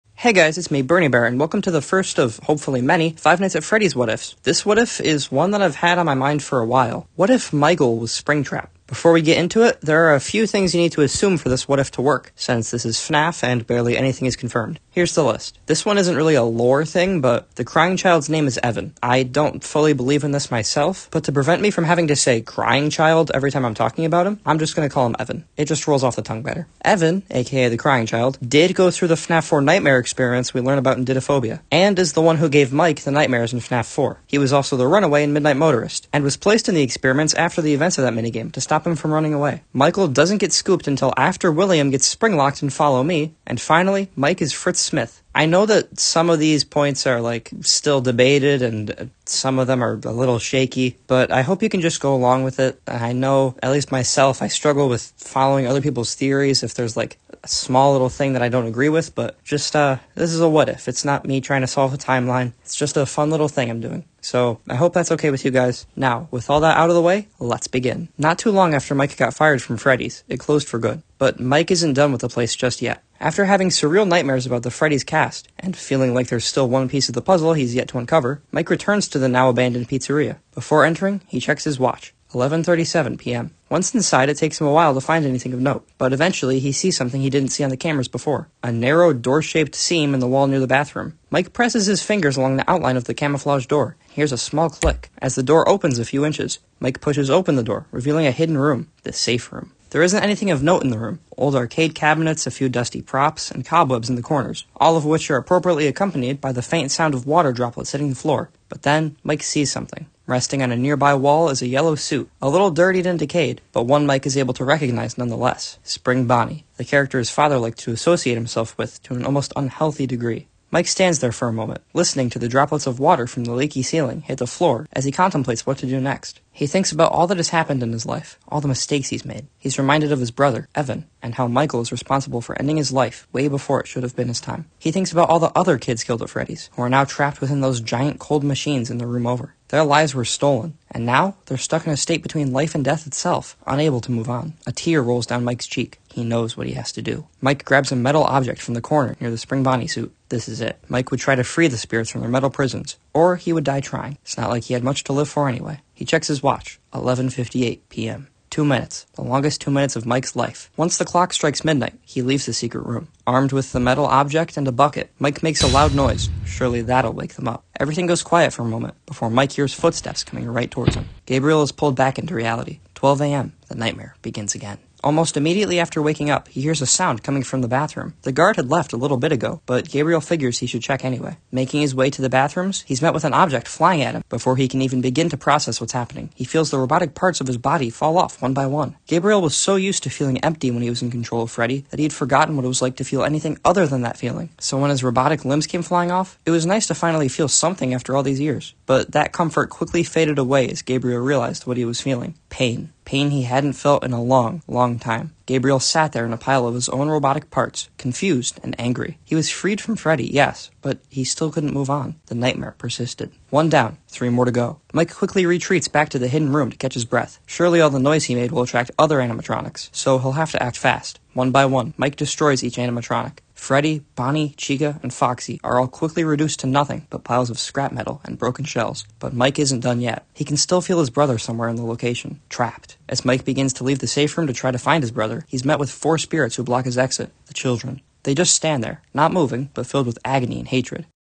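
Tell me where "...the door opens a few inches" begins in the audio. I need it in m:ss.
1:35.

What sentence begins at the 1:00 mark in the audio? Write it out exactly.
It's not me trying to solve a timeline.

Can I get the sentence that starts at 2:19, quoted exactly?
Their lives were stolen, and now they're stuck in a state between life and death itself, unable to move on.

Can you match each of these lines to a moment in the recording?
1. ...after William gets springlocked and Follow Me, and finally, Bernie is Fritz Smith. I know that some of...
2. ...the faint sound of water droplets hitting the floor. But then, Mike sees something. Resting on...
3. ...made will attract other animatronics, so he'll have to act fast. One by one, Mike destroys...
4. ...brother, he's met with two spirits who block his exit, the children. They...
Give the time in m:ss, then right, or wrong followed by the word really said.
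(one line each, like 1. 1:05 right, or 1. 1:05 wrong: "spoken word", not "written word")
1. 0:41 wrong: "Mike", not "Bernie"
2. 1:46 right
3. 3:38 right
4. 3:55 wrong: "four", not "two".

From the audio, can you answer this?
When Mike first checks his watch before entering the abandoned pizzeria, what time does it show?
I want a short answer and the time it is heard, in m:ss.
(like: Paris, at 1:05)
11:37 p.m., at 1:22.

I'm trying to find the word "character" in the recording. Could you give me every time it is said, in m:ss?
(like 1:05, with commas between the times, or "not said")
1:56.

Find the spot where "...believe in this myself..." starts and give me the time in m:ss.
0:19.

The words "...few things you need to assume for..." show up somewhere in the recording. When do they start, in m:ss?
0:10.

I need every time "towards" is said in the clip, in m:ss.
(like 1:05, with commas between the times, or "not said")
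2:50.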